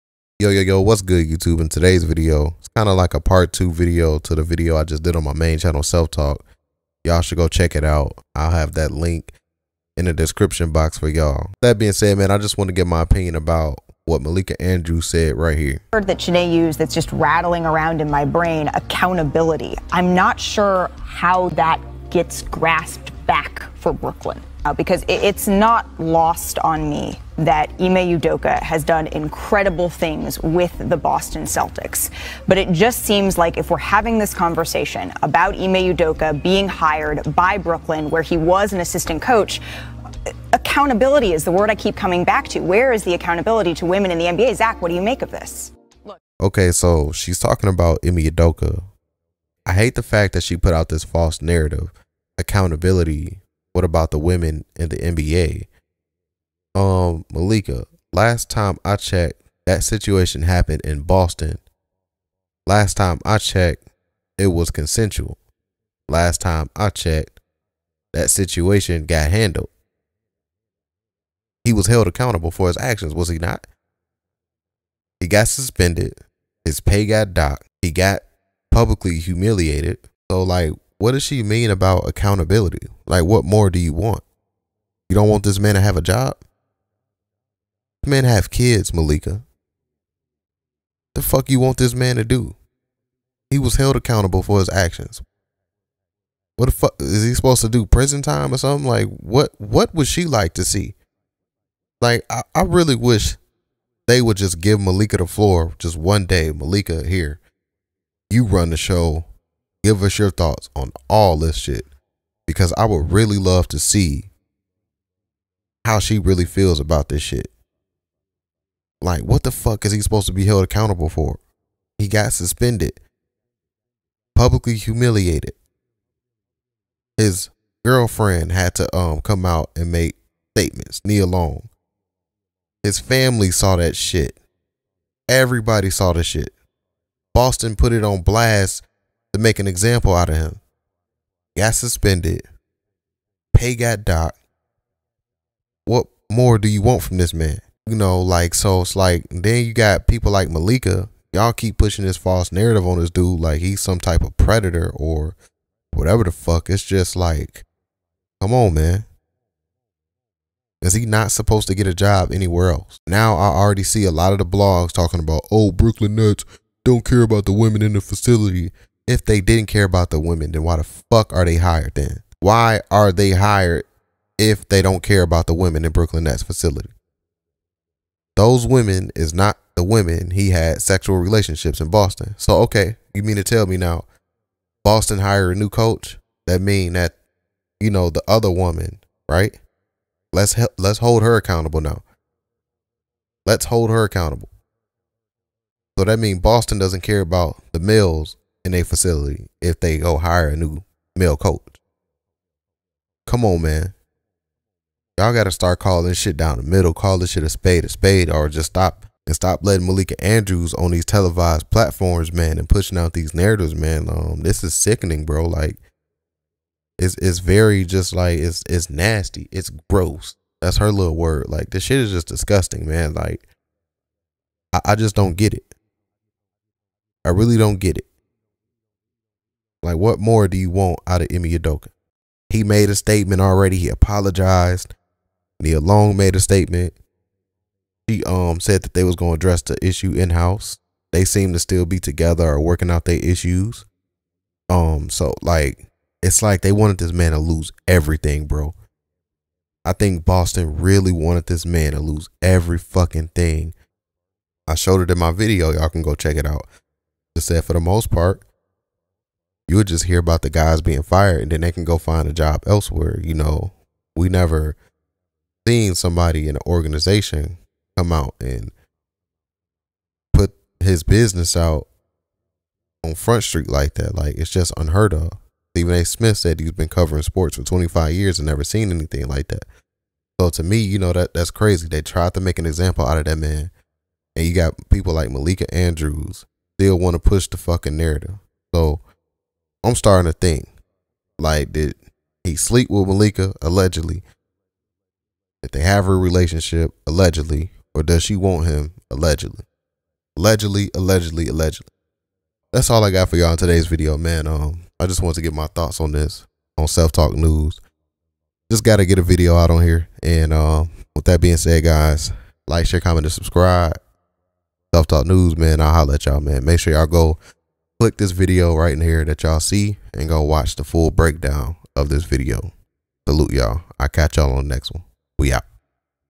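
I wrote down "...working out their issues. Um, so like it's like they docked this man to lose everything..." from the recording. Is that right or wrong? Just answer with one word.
wrong.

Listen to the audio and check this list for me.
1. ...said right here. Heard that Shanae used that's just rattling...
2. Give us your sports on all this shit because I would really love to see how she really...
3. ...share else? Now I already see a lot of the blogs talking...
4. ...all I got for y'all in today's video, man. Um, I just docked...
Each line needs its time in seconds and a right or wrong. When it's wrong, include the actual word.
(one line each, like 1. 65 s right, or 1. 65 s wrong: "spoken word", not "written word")
1. 15 s right
2. 109 s wrong: "thoughts", not "sports"
3. 162 s wrong: "anywhere", not "share"
4. 302 s wrong: "wanted", not "docked".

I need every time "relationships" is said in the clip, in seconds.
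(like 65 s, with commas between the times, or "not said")
181 s, 296 s.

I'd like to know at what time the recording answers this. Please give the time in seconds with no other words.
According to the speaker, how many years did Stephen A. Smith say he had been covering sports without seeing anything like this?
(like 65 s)
277 s.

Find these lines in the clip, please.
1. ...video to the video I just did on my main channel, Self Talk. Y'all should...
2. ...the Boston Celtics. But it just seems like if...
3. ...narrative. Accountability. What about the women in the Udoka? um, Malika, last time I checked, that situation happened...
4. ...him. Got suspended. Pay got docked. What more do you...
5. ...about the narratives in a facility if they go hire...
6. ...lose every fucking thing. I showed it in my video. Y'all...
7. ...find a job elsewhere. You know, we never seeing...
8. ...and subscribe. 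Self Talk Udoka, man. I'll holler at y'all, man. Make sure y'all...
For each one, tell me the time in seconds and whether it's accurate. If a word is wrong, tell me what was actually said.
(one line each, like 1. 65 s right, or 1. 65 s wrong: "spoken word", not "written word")
1. 3 s right
2. 30 s right
3. 51 s wrong: "NBA", not "Udoka"
4. 140 s right
5. 197 s wrong: "males", not "narratives"
6. 251 s right
7. 261 s right
8. 313 s wrong: "News", not "Udoka".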